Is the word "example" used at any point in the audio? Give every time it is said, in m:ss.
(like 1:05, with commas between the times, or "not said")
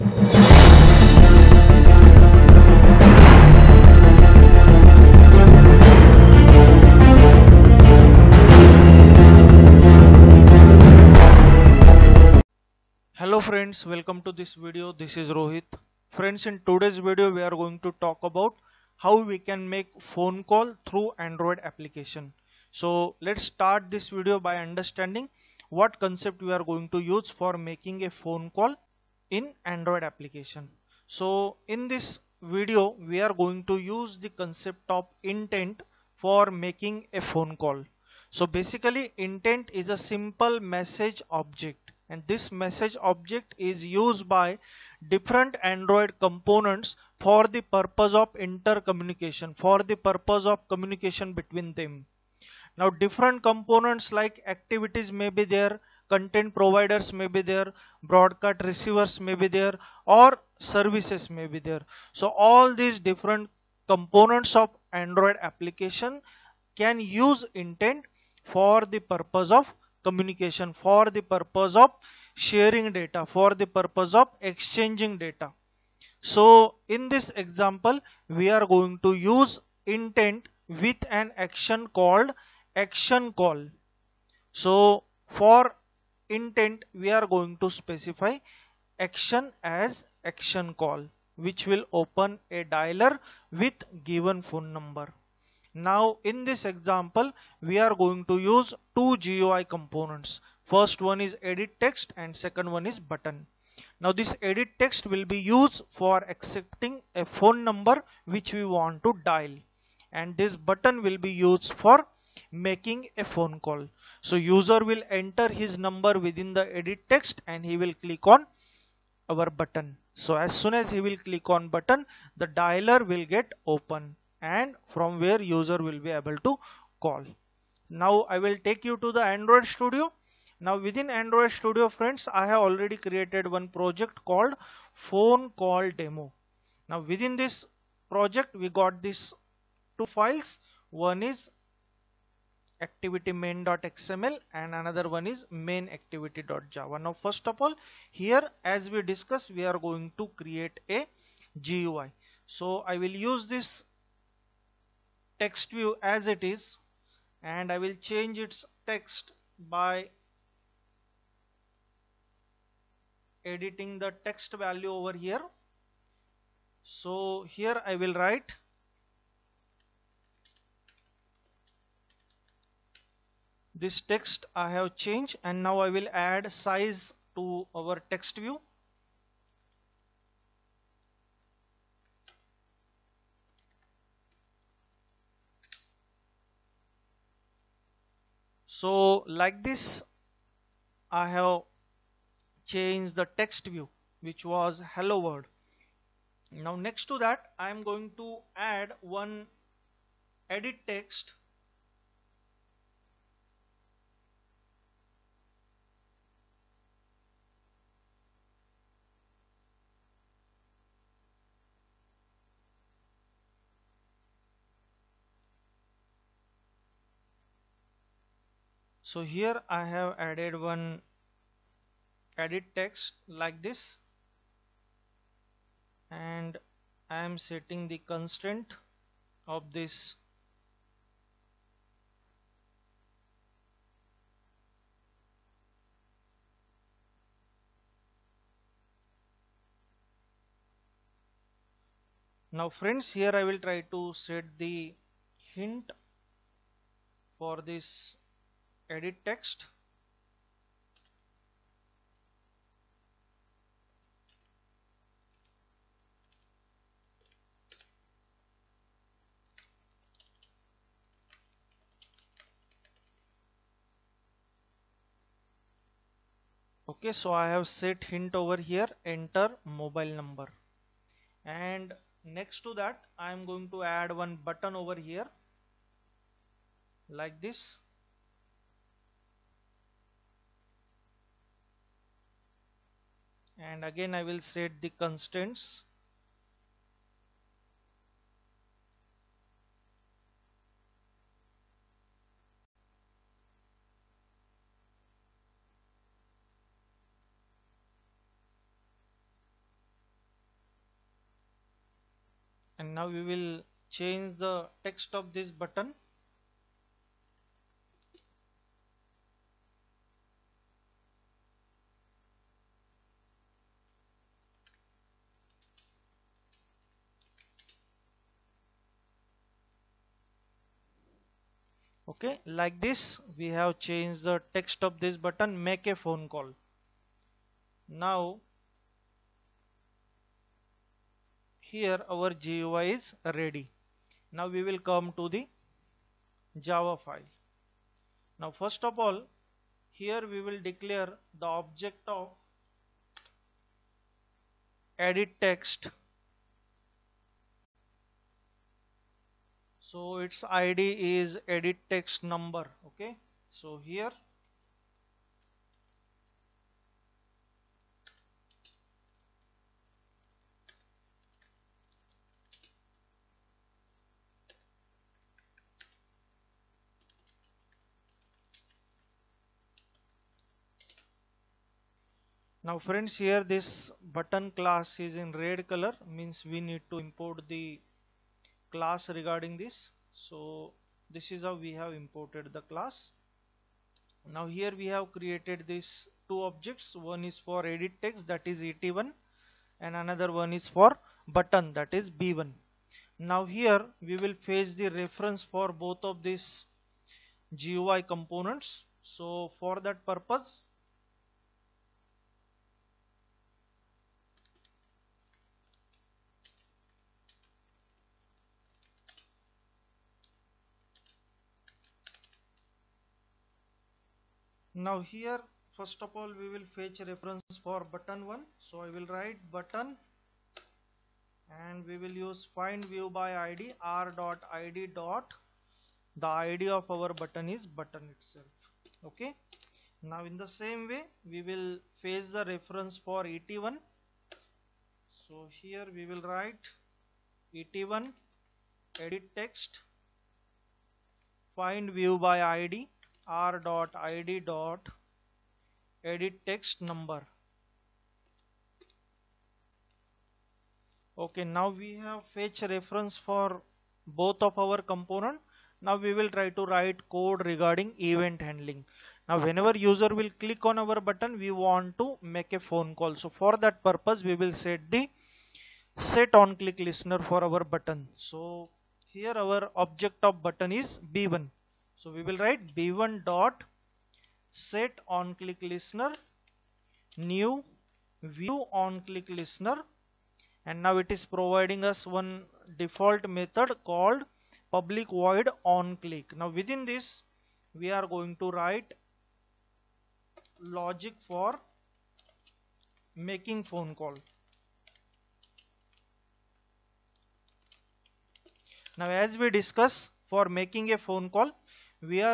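1:17, 1:36.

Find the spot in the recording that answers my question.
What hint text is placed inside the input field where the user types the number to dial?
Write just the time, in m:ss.
4:29.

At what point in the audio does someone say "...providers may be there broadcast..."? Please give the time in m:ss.
0:56.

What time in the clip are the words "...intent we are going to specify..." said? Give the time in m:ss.
1:26.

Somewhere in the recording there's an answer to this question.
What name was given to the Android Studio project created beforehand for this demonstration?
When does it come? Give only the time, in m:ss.
2:14.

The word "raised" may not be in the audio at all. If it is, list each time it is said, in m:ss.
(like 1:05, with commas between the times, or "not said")
not said.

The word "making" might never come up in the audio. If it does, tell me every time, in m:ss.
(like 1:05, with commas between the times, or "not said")
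0:27, 0:36, 1:52, 8:13, 8:20.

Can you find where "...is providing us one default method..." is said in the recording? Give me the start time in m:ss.
8:01.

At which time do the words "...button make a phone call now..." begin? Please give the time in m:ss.
5:25.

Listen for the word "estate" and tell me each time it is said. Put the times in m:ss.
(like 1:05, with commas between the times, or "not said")
not said.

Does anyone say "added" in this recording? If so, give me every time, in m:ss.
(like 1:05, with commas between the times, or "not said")
3:40.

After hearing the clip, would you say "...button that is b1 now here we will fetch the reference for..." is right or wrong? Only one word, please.
right.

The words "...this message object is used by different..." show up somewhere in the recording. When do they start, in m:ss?
0:42.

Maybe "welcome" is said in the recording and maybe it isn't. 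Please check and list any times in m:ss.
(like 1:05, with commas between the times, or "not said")
0:13.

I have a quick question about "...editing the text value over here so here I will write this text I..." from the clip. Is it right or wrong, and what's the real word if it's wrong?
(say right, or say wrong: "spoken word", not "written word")
right.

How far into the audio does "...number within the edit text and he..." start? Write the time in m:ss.
1:55.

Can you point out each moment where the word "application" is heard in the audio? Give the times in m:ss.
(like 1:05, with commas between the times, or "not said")
0:21, 0:30, 1:05.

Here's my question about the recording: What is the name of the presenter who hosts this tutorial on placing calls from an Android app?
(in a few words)
Rohit.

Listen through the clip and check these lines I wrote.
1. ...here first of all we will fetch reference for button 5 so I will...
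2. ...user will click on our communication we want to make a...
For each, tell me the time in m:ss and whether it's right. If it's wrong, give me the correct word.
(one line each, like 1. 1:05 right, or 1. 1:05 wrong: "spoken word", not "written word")
1. 6:55 wrong: "1", not "5"
2. 7:39 wrong: "button", not "communication".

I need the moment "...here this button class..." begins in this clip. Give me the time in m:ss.
6:13.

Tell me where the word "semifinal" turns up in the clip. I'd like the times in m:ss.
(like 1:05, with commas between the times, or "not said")
not said.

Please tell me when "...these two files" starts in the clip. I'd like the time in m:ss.
2:19.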